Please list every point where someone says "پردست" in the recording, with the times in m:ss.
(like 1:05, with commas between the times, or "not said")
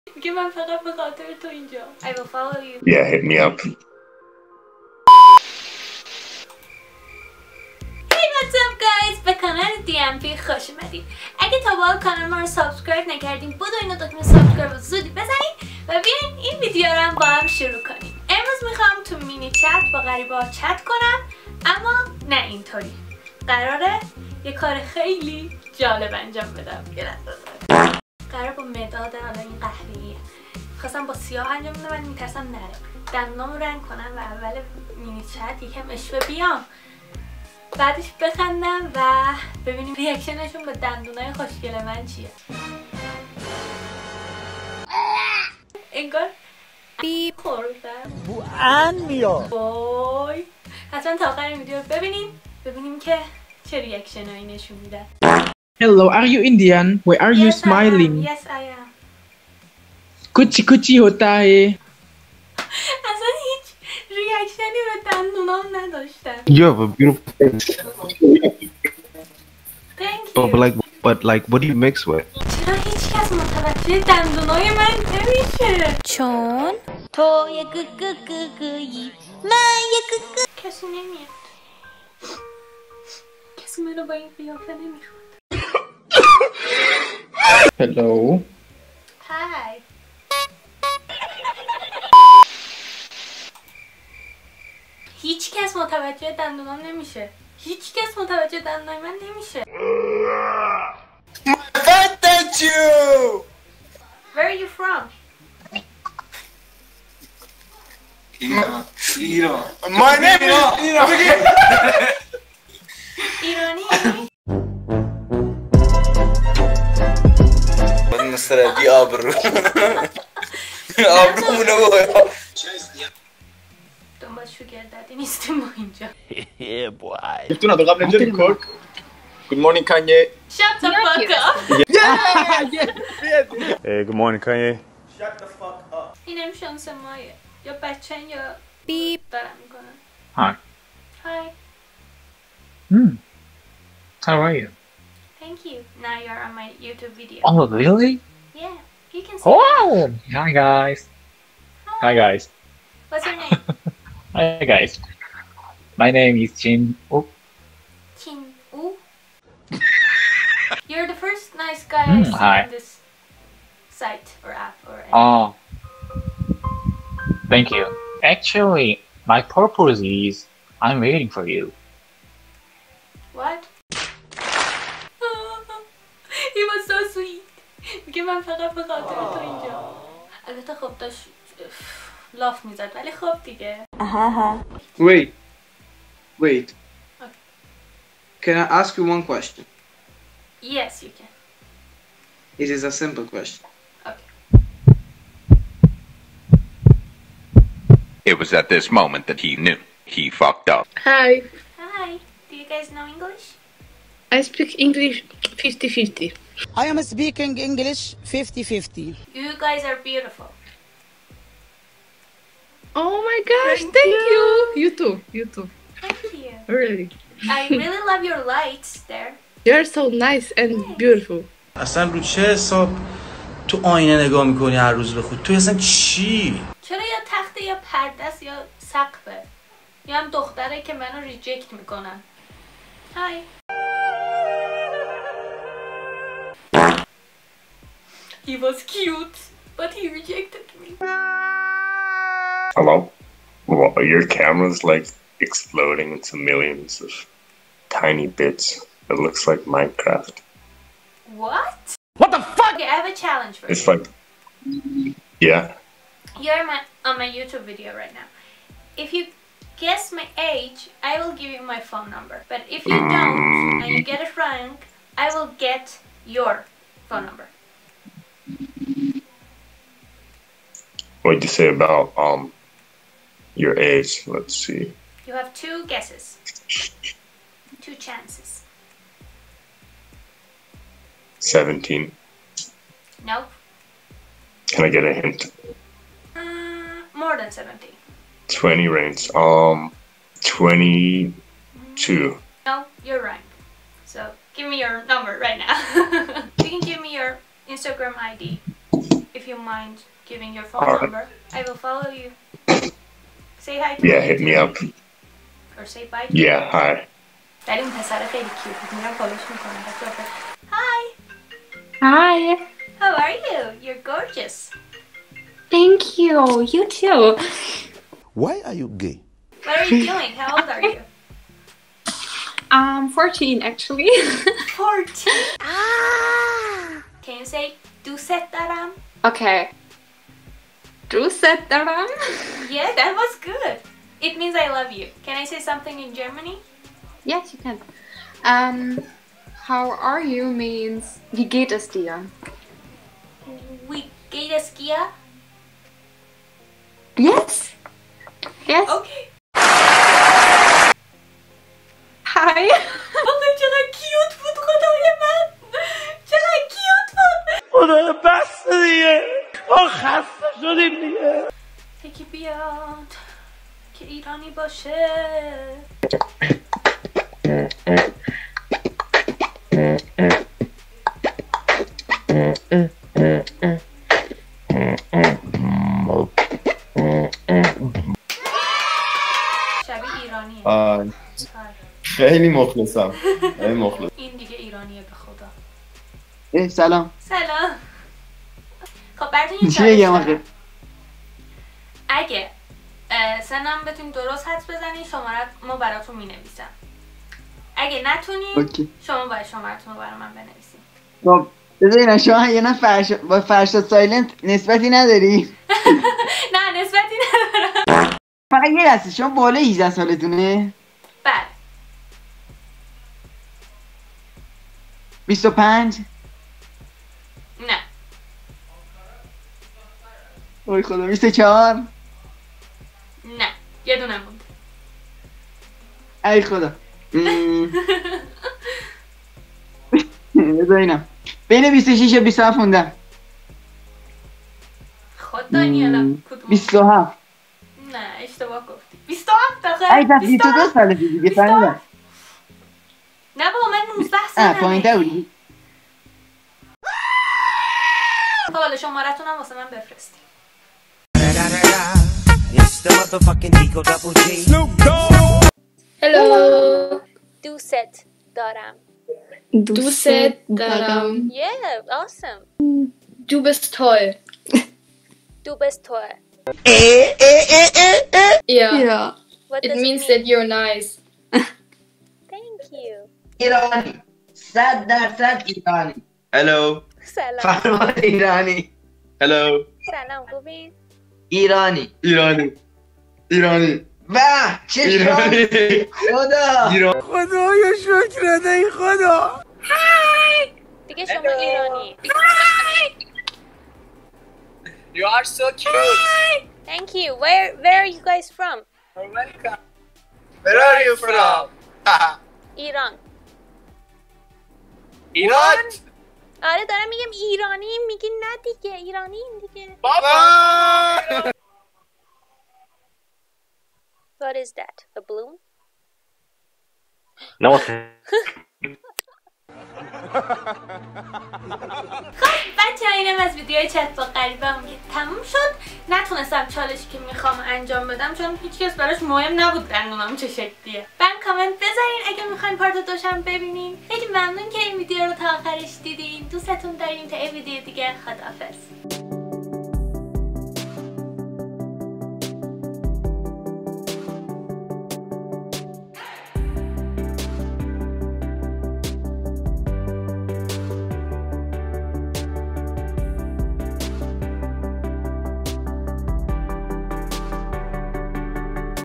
3:47.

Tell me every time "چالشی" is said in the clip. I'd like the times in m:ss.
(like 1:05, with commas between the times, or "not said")
8:46.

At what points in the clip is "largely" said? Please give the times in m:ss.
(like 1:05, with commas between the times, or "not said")
not said.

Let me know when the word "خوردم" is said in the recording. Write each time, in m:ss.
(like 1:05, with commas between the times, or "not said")
0:47.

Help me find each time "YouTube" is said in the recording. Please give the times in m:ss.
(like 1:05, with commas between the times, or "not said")
2:26, 4:17.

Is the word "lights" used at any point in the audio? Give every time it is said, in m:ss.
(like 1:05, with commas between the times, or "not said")
3:38.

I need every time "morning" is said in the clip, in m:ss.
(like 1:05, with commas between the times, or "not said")
2:09, 2:14.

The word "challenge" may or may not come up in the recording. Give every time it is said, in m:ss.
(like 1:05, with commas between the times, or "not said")
4:13.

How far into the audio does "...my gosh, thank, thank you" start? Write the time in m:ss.
3:33.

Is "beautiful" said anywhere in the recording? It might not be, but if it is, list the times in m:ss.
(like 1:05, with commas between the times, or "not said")
1:06, 3:29, 3:40.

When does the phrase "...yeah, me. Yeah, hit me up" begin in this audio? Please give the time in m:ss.
5:04.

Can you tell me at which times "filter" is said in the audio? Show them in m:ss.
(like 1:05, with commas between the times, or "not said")
not said.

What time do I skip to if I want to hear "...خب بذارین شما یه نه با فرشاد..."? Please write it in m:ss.
6:41.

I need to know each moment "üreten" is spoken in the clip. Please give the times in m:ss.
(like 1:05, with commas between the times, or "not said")
1:04.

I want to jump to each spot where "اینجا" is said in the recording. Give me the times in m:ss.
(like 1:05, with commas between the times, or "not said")
0:01, 2:59.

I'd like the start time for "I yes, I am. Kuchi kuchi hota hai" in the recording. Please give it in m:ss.
0:58.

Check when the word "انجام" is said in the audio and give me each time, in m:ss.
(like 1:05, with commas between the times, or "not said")
0:26, 0:31, 8:47.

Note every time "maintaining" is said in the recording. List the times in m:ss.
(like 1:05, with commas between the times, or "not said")
not said.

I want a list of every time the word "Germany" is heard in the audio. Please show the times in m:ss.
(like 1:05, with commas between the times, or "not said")
5:36.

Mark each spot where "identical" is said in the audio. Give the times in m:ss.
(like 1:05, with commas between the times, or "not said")
not said.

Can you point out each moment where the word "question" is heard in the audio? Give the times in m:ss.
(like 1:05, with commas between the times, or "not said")
3:09, 3:13.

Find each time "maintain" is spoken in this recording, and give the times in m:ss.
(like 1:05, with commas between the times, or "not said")
not said.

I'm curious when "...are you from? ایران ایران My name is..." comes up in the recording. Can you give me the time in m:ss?
1:44.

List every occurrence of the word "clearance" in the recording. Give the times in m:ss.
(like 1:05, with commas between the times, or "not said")
not said.